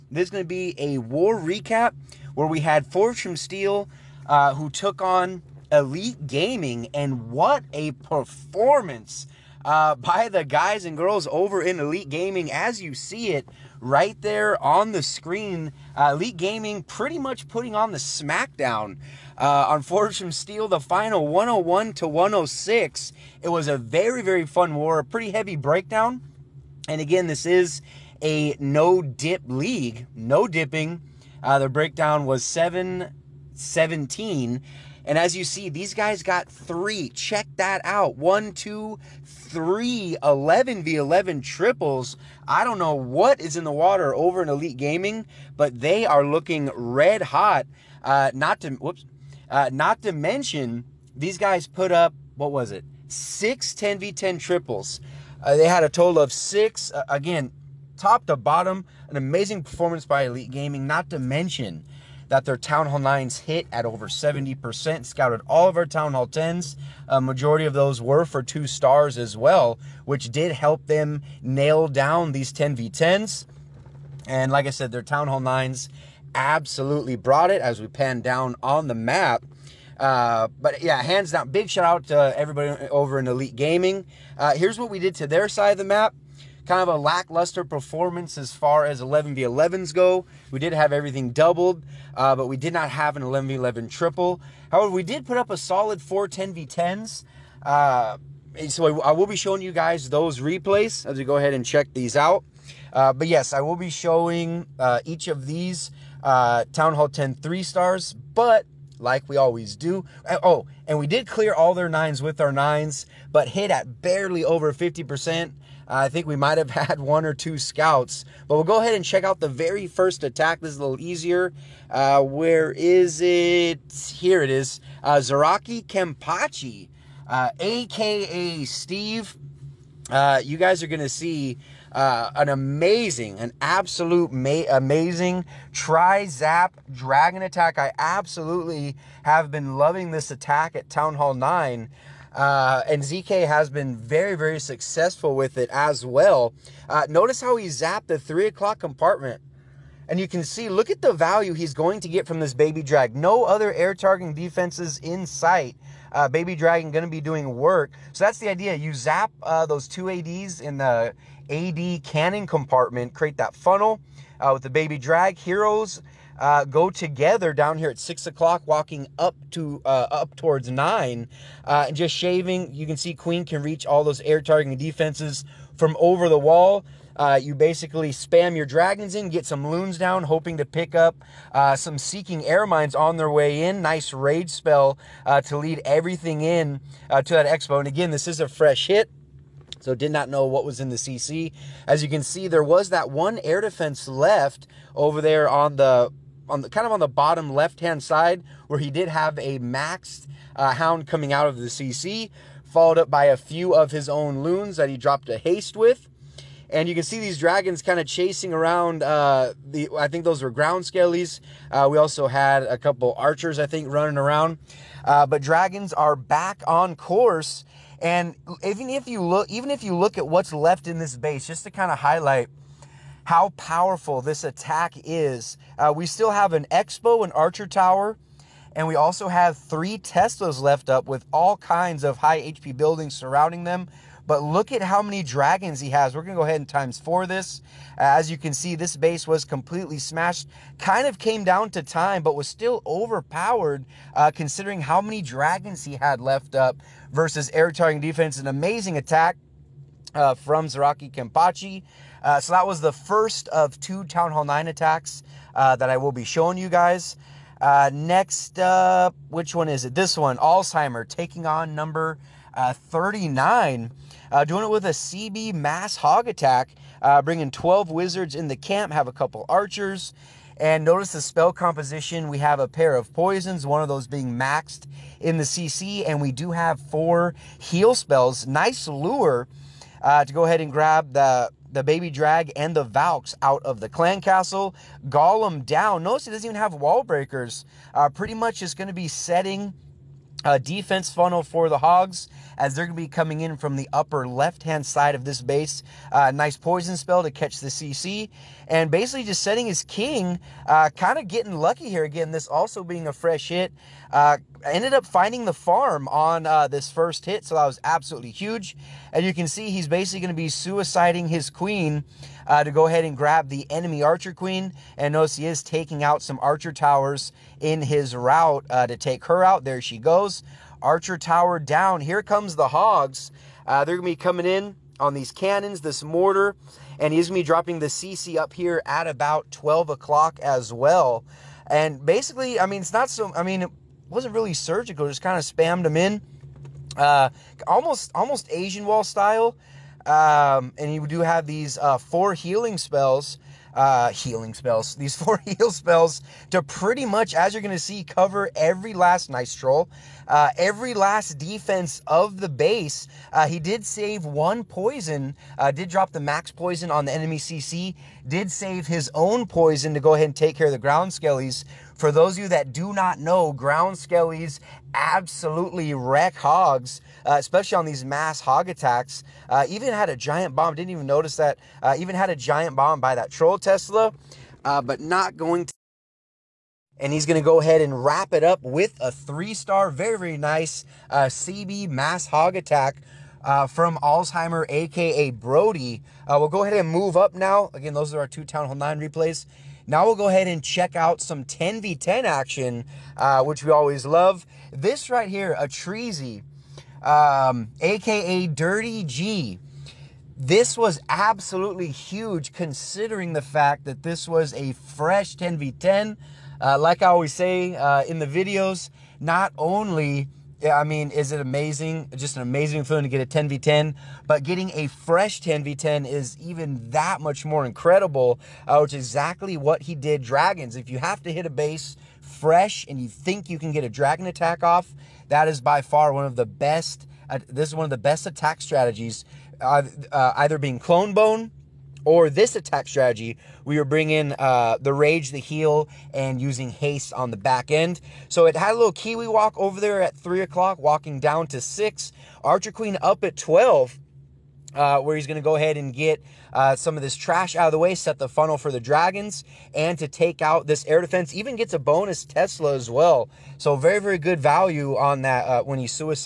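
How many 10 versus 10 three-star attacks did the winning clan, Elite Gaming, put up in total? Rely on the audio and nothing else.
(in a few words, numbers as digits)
6.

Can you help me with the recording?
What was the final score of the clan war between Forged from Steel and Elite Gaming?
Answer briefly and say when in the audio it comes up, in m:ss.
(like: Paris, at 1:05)
101 to 106, at 0:21.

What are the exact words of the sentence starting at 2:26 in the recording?
Uh, notice how he zapped the three o'clock compartment.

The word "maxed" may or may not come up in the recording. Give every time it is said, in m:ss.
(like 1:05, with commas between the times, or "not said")
3:19, 4:34.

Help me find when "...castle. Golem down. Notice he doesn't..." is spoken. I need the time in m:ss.
4:44.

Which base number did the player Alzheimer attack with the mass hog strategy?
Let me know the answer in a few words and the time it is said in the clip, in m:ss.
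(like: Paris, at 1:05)
39, at 4:22.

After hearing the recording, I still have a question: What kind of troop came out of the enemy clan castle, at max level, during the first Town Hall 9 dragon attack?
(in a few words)
Hound.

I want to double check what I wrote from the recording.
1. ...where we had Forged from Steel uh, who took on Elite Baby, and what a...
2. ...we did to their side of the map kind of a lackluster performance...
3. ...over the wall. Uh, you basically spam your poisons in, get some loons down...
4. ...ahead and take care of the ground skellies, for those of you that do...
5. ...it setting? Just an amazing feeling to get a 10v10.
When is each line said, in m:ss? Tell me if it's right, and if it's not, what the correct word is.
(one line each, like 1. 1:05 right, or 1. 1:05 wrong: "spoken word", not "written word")
1. 0:02 wrong: "Gaming", not "Baby"
2. 1:24 right
3. 2:55 wrong: "dragons", not "poisons"
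4. 6:00 right
5. 6:51 wrong: "amazing", not "setting".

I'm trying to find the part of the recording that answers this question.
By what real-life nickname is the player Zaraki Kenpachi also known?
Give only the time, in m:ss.
2:08.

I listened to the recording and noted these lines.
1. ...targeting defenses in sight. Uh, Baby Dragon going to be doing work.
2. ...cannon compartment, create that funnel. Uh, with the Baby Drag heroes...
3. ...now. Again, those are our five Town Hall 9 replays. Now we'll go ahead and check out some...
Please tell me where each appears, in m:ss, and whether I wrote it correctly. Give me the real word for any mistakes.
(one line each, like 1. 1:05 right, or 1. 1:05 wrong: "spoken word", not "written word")
1. 2:33 right
2. 2:42 right
3. 6:27 wrong: "two", not "five".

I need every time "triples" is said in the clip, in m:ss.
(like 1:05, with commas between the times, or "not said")
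0:41, 0:54, 1:33.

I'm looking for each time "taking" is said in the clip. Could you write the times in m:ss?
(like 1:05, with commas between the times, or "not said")
4:21, 5:15.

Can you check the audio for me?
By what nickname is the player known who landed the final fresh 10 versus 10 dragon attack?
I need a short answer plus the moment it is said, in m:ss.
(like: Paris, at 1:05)
Dirty G, at 6:38.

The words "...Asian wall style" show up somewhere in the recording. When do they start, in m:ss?
5:38.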